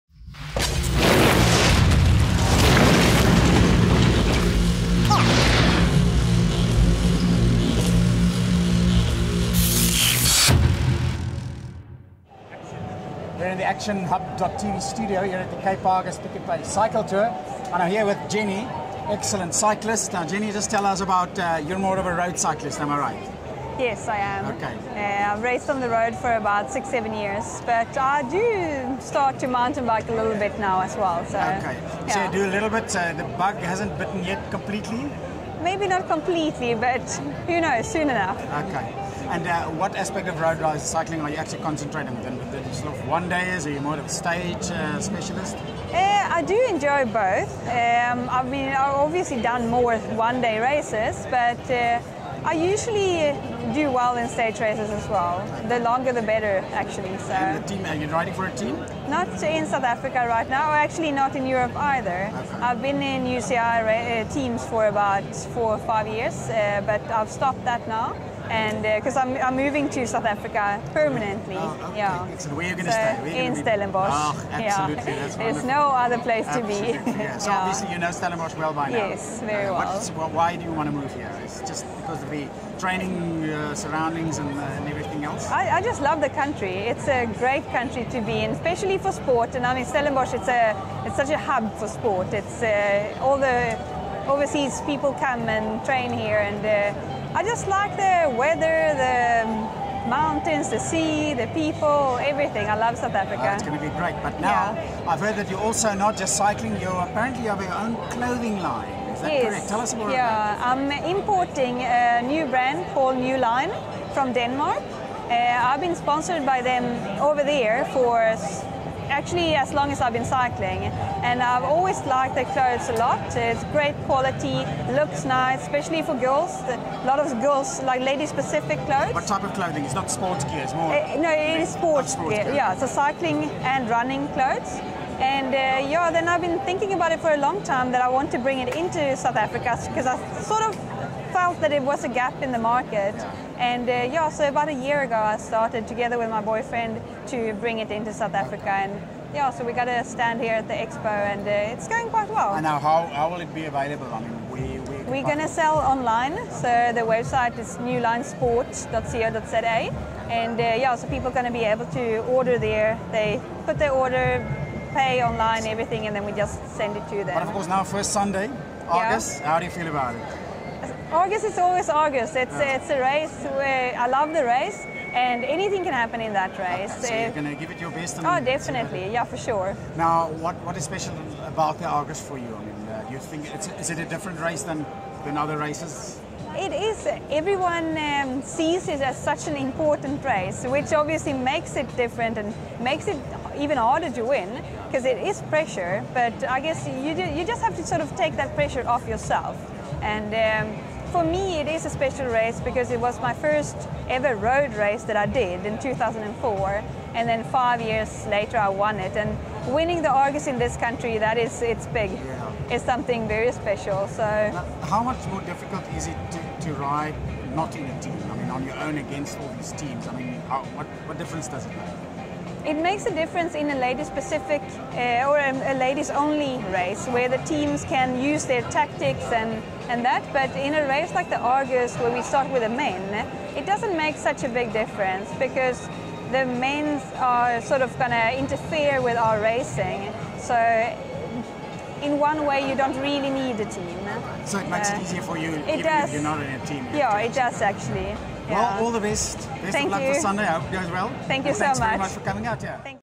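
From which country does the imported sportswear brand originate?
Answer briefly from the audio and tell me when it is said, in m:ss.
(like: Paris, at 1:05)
Denmark, at 1:54.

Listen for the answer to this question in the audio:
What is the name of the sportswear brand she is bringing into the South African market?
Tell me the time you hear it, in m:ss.
1:53.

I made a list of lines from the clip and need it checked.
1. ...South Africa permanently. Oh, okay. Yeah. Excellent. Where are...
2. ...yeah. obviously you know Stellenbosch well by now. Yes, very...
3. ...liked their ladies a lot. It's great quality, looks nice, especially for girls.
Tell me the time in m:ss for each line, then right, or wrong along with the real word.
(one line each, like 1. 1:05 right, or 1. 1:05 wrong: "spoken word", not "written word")
1. 1:10 right
2. 1:17 right
3. 2:02 wrong: "clothes", not "ladies".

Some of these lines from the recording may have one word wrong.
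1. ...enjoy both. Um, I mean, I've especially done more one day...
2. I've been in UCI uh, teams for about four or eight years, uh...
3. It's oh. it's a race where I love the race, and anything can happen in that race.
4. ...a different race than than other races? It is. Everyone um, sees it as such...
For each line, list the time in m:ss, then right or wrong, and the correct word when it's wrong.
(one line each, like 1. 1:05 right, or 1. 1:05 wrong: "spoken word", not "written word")
1. 0:46 wrong: "obviously", not "especially"
2. 1:02 wrong: "five", not "eight"
3. 2:52 right
4. 3:03 right.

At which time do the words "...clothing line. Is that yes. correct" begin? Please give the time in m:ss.
1:48.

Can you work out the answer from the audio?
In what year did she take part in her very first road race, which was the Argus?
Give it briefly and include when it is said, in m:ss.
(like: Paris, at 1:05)
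2004, at 3:25.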